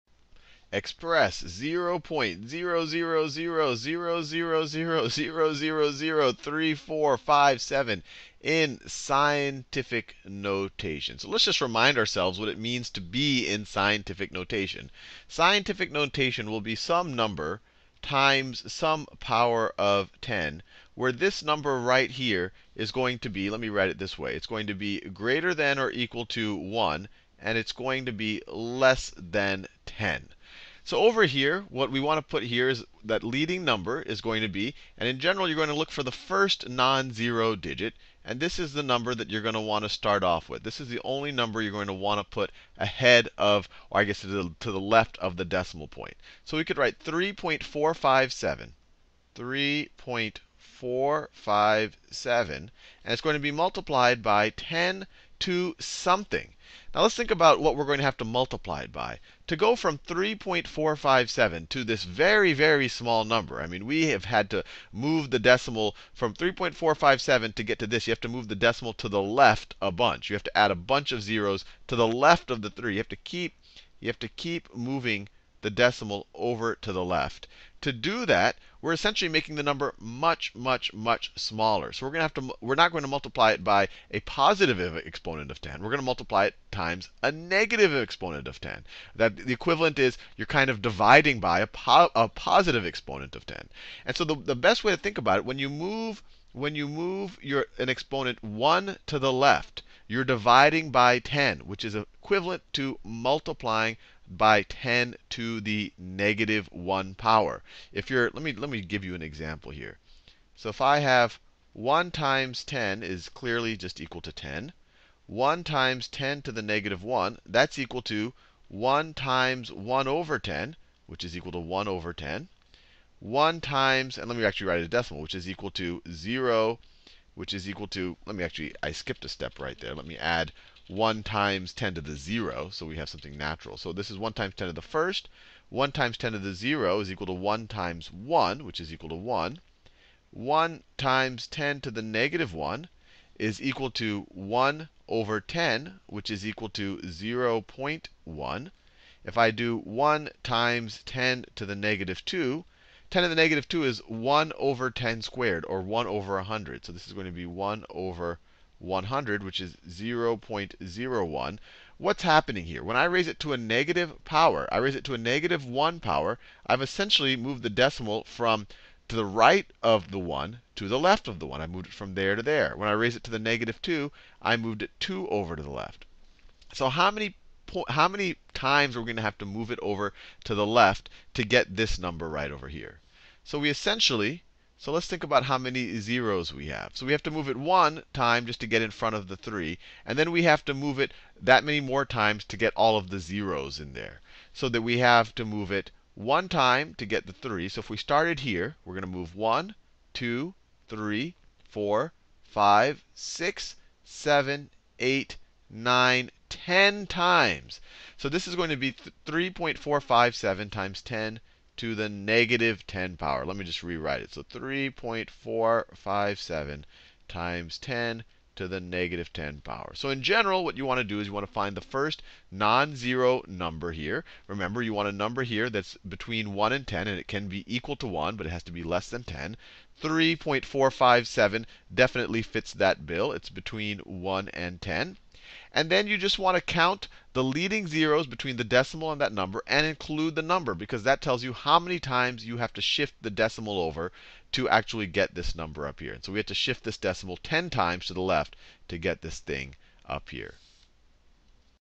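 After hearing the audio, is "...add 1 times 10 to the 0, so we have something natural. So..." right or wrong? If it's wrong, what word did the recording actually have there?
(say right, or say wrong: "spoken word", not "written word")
right.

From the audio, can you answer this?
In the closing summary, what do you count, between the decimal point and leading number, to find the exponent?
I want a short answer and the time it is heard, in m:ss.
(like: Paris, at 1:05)
leading zeros, at 3:57.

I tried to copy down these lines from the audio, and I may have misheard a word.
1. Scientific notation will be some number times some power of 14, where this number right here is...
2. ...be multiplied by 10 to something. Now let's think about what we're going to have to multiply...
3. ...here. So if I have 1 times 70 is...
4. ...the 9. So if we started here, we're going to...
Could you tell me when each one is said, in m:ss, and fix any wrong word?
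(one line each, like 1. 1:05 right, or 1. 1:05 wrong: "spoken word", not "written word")
1. 0:15 wrong: "10", not "14"
2. 0:53 right
3. 1:49 wrong: "10", not "70"
4. 3:17 wrong: "3", not "9".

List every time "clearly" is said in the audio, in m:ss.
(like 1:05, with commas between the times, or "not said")
1:53.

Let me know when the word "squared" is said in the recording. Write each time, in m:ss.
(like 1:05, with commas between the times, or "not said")
2:35.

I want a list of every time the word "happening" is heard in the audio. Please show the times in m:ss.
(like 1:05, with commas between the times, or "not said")
2:42.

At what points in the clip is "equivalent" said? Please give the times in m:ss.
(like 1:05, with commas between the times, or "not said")
1:29, 1:41.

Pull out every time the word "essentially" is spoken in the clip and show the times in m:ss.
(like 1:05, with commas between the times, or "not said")
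1:18, 2:46, 3:03.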